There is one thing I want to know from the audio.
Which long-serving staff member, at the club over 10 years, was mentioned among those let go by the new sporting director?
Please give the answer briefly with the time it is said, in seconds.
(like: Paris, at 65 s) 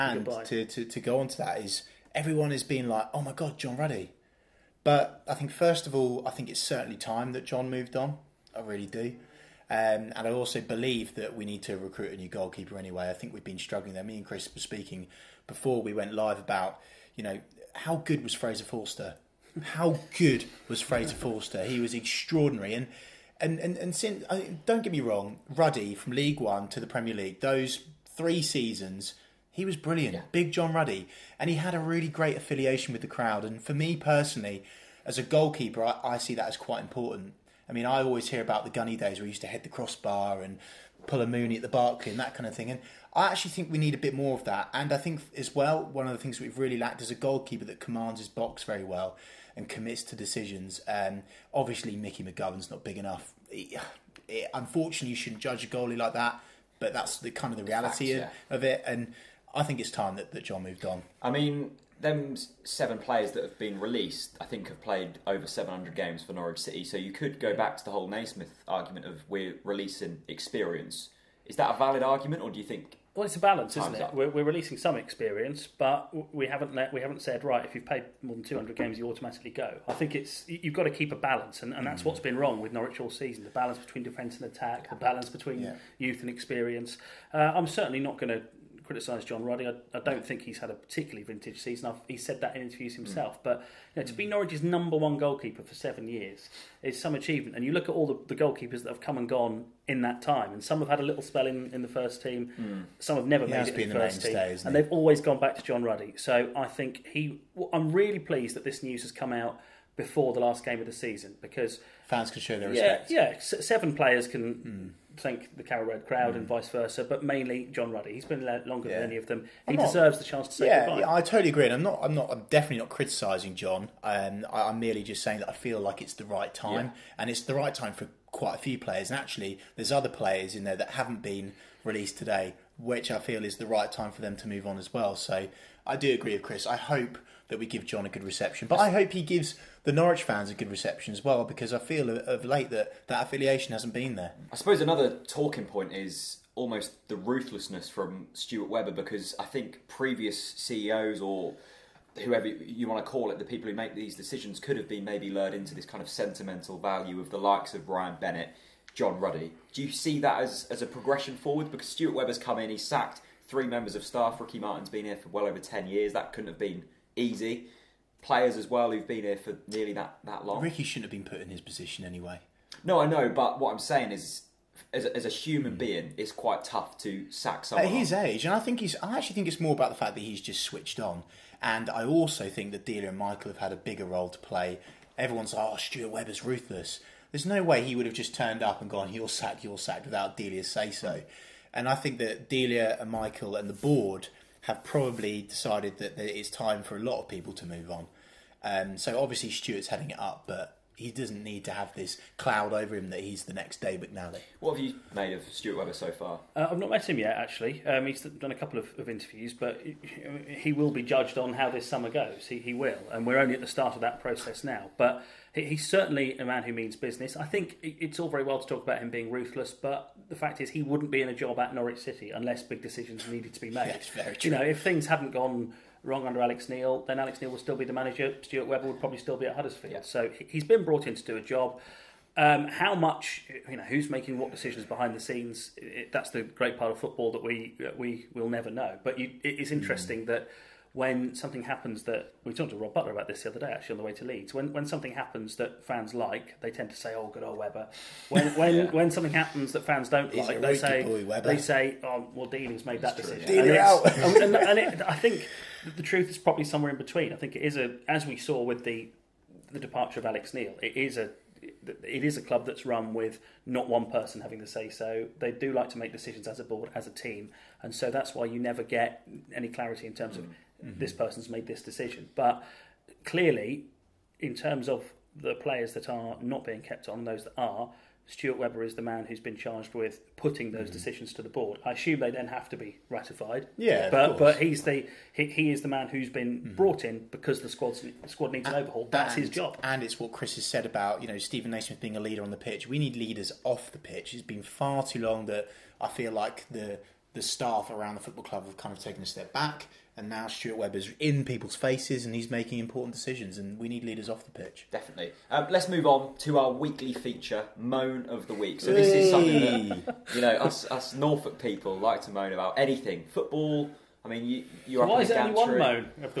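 Ricky Martin, at 164 s.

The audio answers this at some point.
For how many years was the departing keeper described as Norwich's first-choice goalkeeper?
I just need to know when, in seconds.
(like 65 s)
95 s.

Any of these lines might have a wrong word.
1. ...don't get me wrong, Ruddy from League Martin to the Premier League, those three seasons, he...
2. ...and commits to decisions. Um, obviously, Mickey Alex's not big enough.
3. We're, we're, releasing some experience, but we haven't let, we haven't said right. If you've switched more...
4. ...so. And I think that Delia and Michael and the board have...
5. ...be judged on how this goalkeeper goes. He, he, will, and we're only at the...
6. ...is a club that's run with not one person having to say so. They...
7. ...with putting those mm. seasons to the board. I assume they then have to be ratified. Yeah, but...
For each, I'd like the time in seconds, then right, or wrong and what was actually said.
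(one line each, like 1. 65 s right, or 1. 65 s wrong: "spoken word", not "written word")
1. 24 s wrong: "One", not "Martin"
2. 49 s wrong: "McGovern", not "Alex"
3. 74 s wrong: "played", not "switched"
4. 190 s right
5. 210 s wrong: "summer", not "goalkeeper"
6. 262 s right
7. 279 s wrong: "decisions", not "seasons".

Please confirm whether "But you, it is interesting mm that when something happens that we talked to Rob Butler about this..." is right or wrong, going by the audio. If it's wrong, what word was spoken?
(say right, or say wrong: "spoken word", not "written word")
right.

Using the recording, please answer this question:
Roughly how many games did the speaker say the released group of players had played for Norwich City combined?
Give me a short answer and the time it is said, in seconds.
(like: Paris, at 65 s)
700, at 65 s.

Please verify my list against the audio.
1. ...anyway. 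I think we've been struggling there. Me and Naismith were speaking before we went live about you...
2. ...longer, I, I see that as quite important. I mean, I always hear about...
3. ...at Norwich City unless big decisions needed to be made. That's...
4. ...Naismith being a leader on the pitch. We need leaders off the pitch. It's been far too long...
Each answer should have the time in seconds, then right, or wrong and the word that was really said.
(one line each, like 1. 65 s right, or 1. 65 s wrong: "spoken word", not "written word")
1. 12 s wrong: "Chris", not "Naismith"
2. 35 s wrong: "goalkeeper", not "longer"
3. 221 s right
4. 291 s right.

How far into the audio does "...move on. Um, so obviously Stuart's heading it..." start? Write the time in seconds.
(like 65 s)
197 s.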